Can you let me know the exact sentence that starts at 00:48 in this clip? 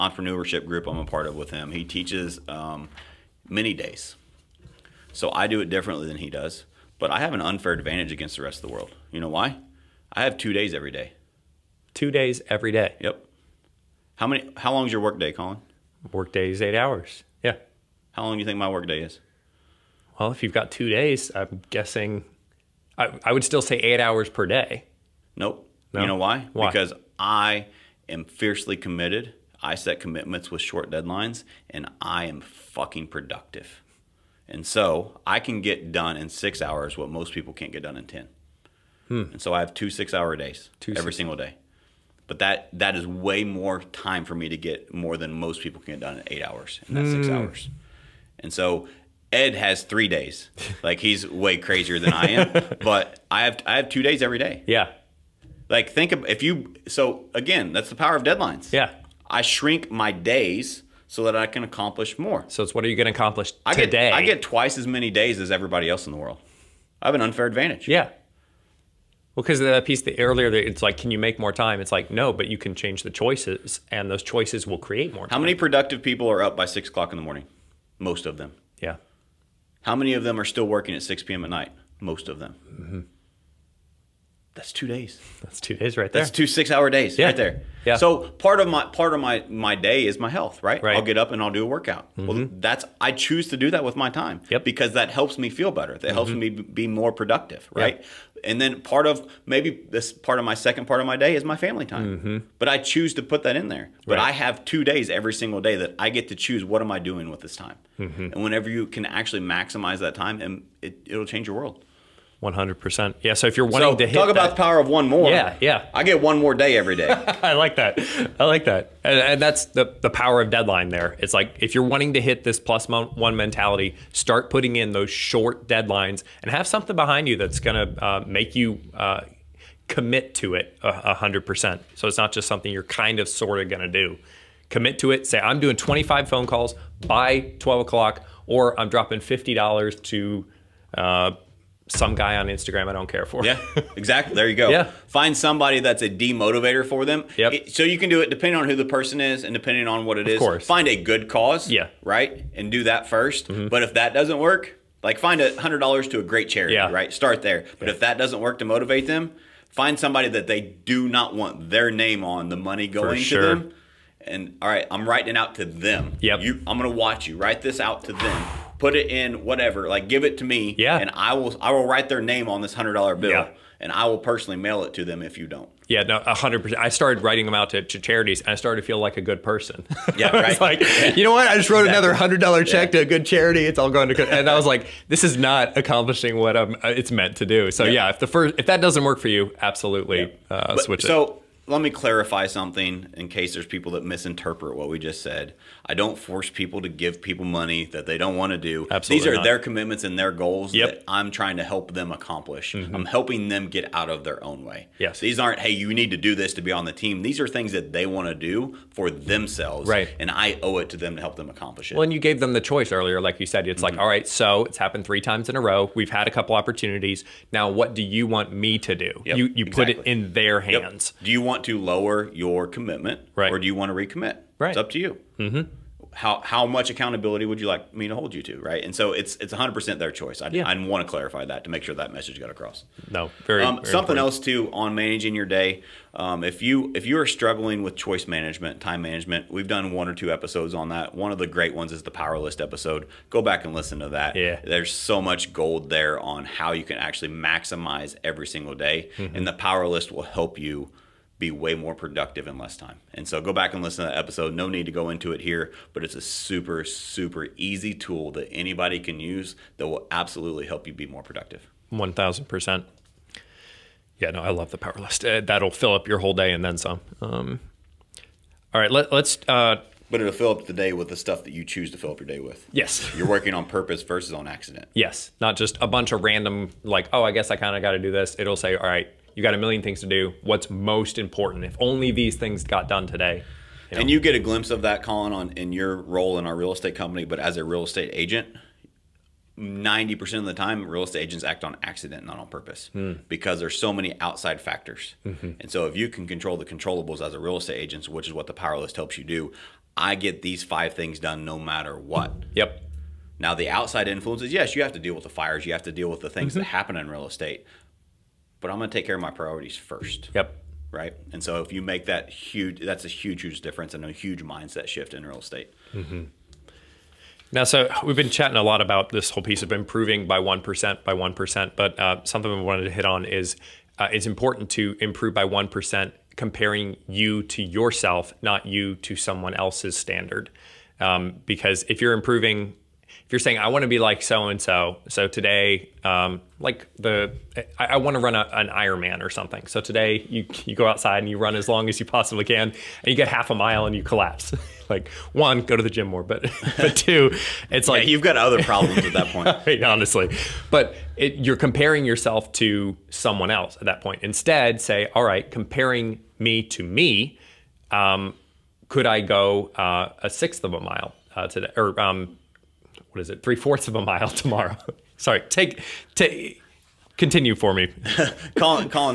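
And so Ed has three days.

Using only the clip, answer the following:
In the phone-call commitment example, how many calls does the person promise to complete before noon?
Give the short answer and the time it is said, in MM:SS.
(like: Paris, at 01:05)
25, at 02:15.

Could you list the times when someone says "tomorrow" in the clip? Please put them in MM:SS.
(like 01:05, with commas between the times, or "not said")
06:04.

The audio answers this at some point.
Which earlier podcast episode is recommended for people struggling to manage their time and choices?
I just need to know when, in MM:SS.
04:02.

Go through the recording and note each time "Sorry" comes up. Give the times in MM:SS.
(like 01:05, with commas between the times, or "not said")
06:05.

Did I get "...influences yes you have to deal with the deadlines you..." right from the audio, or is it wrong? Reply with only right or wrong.
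wrong.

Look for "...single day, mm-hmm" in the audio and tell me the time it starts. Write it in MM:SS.
04:08.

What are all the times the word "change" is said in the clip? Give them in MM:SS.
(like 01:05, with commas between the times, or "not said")
01:12, 01:51.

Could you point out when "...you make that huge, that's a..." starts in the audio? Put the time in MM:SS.
05:11.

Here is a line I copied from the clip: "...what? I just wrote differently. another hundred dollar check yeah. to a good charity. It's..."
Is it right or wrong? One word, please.
wrong.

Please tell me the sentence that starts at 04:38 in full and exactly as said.
It'll say, all right, you got a million things to do.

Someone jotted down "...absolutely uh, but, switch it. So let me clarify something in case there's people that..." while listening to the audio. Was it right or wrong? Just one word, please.
right.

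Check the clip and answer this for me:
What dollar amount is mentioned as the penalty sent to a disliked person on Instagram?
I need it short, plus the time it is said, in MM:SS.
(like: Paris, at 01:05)
$50, at 02:19.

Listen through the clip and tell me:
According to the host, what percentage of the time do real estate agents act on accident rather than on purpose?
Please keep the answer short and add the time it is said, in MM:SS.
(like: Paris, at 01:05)
90%, at 04:49.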